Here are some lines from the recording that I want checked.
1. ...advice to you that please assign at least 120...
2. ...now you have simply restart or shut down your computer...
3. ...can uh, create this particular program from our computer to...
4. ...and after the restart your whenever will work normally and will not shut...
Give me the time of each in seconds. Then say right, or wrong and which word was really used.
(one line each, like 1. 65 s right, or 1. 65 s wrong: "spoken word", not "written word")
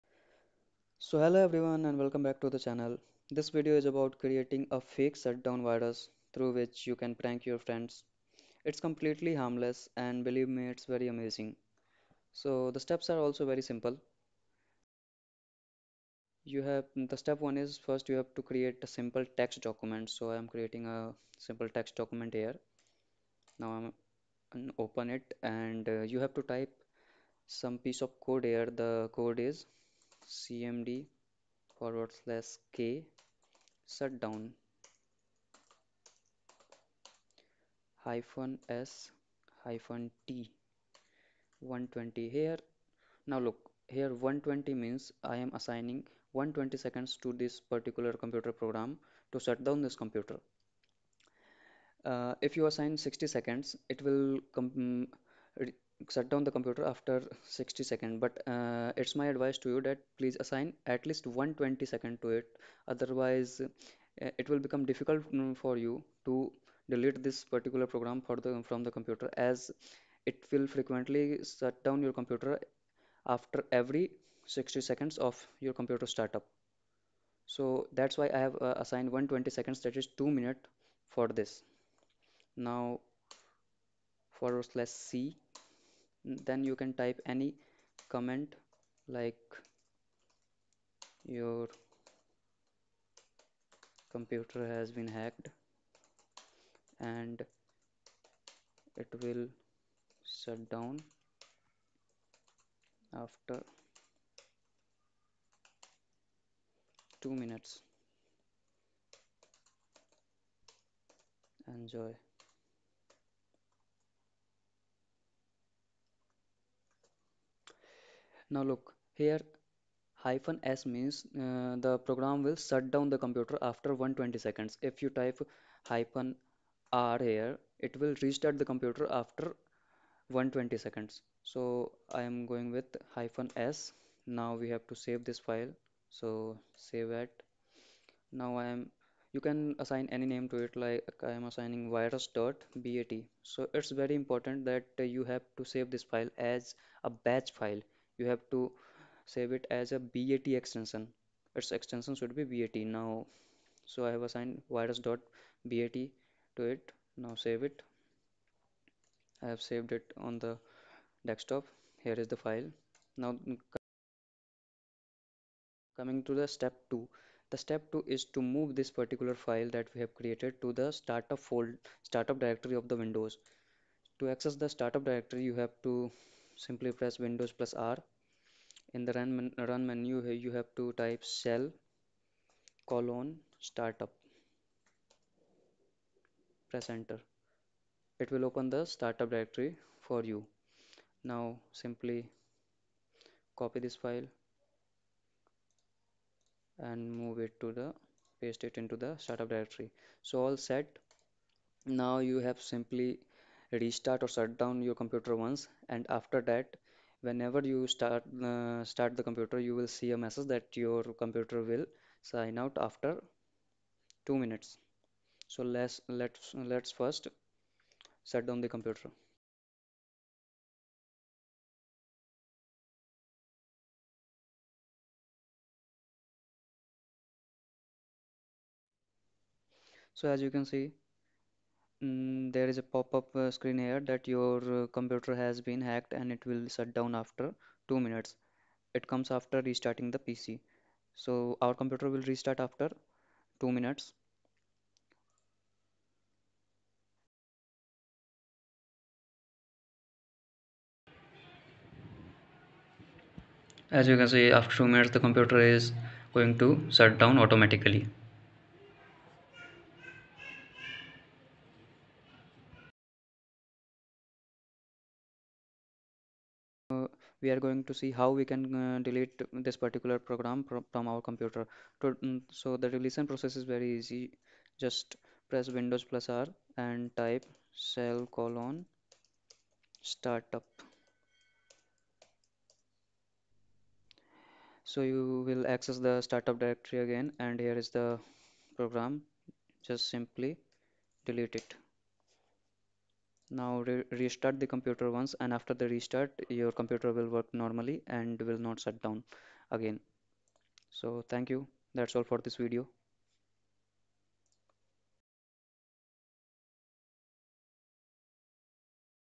1. 59 s right
2. 201 s right
3. 268 s wrong: "delete", not "create"
4. 295 s wrong: "computer", not "whenever".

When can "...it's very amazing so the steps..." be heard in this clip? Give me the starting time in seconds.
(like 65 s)
10 s.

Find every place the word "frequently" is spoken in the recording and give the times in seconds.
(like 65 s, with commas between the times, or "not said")
70 s.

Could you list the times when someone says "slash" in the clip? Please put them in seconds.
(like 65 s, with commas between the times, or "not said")
32 s.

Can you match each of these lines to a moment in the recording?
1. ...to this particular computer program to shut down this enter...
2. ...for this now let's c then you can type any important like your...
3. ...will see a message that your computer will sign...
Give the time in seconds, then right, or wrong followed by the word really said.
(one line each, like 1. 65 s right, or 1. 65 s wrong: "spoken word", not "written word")
1. 47 s wrong: "computer", not "enter"
2. 81 s wrong: "comment", not "important"
3. 209 s right.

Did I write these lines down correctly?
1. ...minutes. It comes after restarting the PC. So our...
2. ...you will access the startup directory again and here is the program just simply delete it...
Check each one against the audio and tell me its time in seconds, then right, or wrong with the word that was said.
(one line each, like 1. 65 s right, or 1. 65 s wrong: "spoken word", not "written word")
1. 237 s right
2. 285 s right.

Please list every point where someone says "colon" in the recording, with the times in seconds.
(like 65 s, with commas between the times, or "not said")
182 s, 278 s.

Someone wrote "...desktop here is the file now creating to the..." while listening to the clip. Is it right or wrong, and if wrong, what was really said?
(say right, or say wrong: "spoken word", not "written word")
wrong: "coming", not "creating".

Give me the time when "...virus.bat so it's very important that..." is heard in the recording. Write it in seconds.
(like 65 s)
141 s.